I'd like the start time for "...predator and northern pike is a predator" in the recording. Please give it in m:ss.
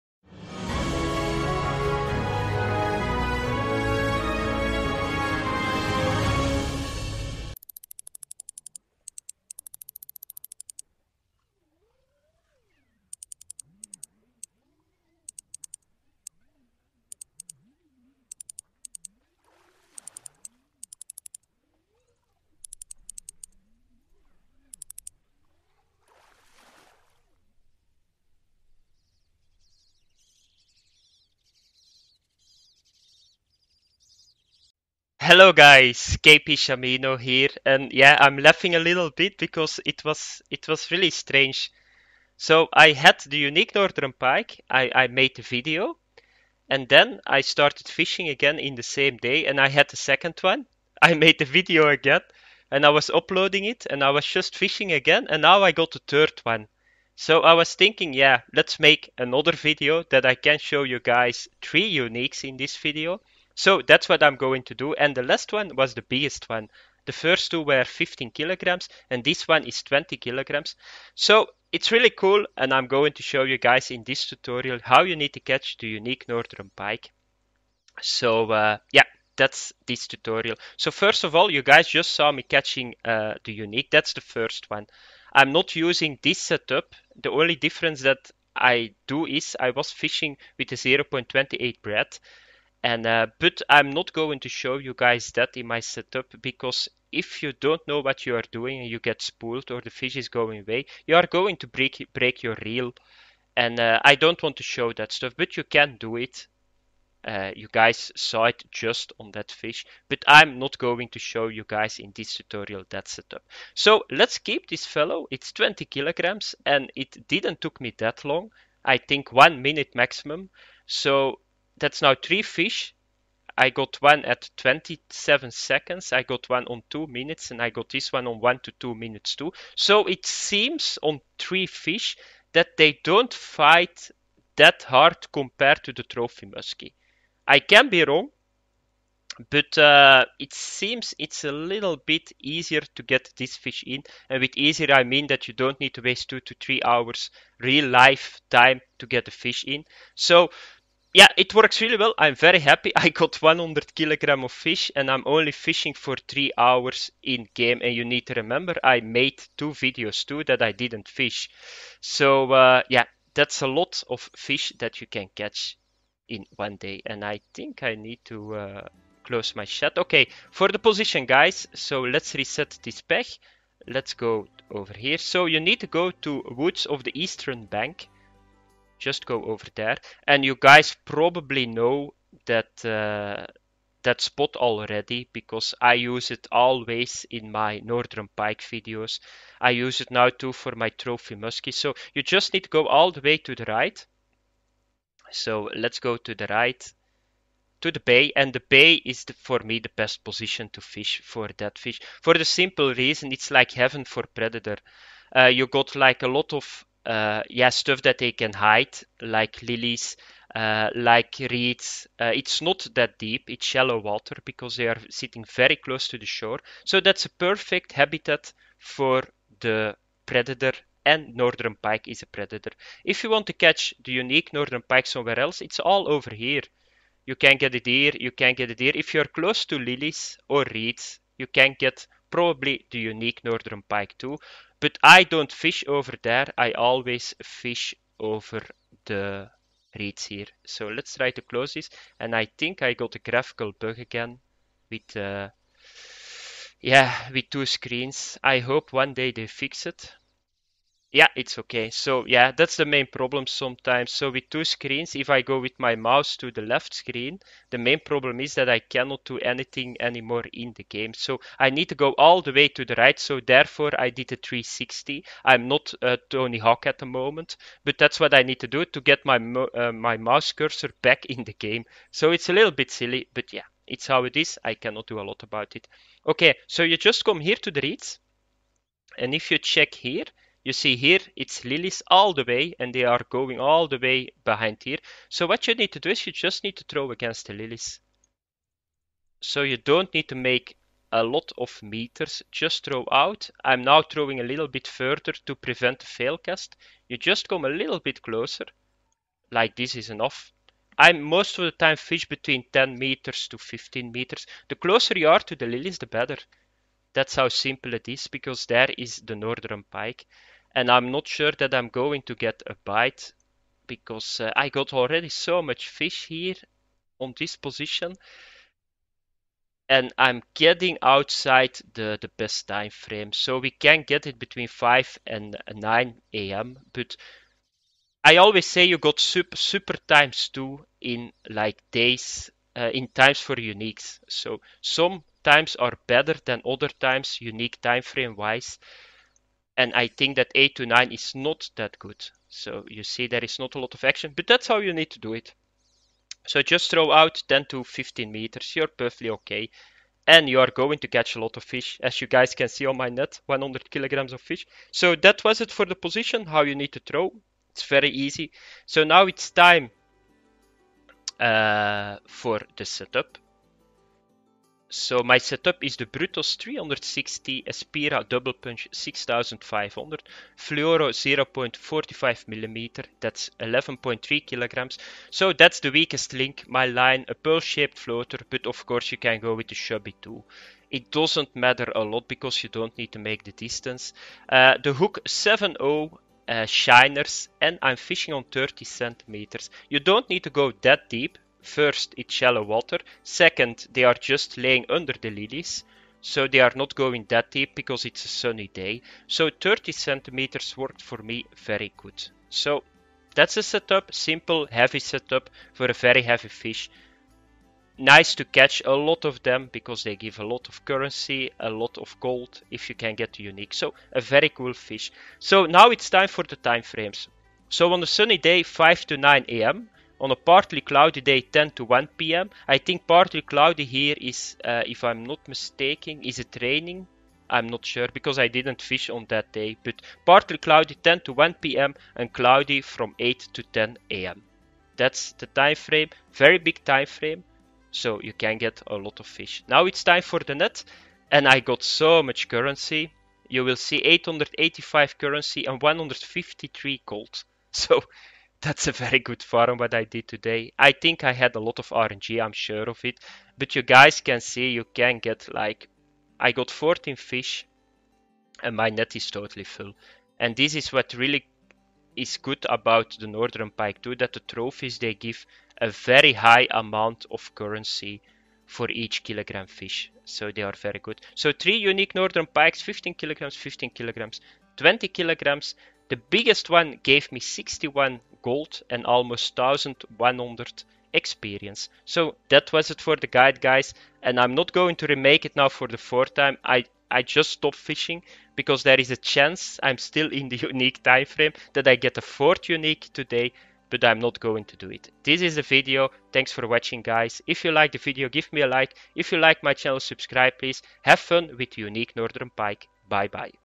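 3:40.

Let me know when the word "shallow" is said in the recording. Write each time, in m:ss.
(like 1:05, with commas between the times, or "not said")
3:33, 6:32.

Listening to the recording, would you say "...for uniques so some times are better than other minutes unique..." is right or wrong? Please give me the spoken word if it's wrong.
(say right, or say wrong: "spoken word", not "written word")
wrong: "times", not "minutes".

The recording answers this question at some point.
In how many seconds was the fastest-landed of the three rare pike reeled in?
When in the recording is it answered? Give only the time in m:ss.
2:04.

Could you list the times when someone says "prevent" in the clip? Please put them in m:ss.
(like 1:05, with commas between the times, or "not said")
4:55.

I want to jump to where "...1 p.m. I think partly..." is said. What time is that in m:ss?
7:01.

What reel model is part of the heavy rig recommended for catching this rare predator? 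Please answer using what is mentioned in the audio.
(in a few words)
Double Punch 6500.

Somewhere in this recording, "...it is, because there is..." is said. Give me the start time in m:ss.
5:07.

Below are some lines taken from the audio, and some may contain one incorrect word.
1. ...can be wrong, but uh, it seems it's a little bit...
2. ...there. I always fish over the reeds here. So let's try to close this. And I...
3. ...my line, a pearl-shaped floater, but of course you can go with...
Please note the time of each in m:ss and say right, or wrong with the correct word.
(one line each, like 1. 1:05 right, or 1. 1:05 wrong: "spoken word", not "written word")
1. 2:17 right
2. 3:56 right
3. 6:16 right.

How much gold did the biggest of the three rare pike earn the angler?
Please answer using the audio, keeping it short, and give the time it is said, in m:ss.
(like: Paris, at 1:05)
61 gold, at 7:57.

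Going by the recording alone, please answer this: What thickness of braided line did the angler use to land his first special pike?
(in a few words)
0.28.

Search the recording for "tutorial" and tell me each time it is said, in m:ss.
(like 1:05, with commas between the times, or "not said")
1:14, 1:20, 1:52.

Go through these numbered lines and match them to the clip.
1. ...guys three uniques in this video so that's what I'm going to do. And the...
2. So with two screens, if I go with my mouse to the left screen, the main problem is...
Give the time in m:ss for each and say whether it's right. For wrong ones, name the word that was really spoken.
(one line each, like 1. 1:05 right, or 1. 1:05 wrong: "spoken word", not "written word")
1. 1:00 right
2. 4:14 right.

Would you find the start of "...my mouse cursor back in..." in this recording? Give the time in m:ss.
4:29.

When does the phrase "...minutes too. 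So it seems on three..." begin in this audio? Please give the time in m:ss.
2:08.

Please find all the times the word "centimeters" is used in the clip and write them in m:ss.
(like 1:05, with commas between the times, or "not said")
6:28, 6:39.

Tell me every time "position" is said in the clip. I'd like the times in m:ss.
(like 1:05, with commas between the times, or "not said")
2:50, 3:20, 5:17, 5:55.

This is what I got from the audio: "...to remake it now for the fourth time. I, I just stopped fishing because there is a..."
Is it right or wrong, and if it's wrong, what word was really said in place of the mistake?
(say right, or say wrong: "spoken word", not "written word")
right.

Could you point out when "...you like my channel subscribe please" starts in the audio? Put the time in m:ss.
8:19.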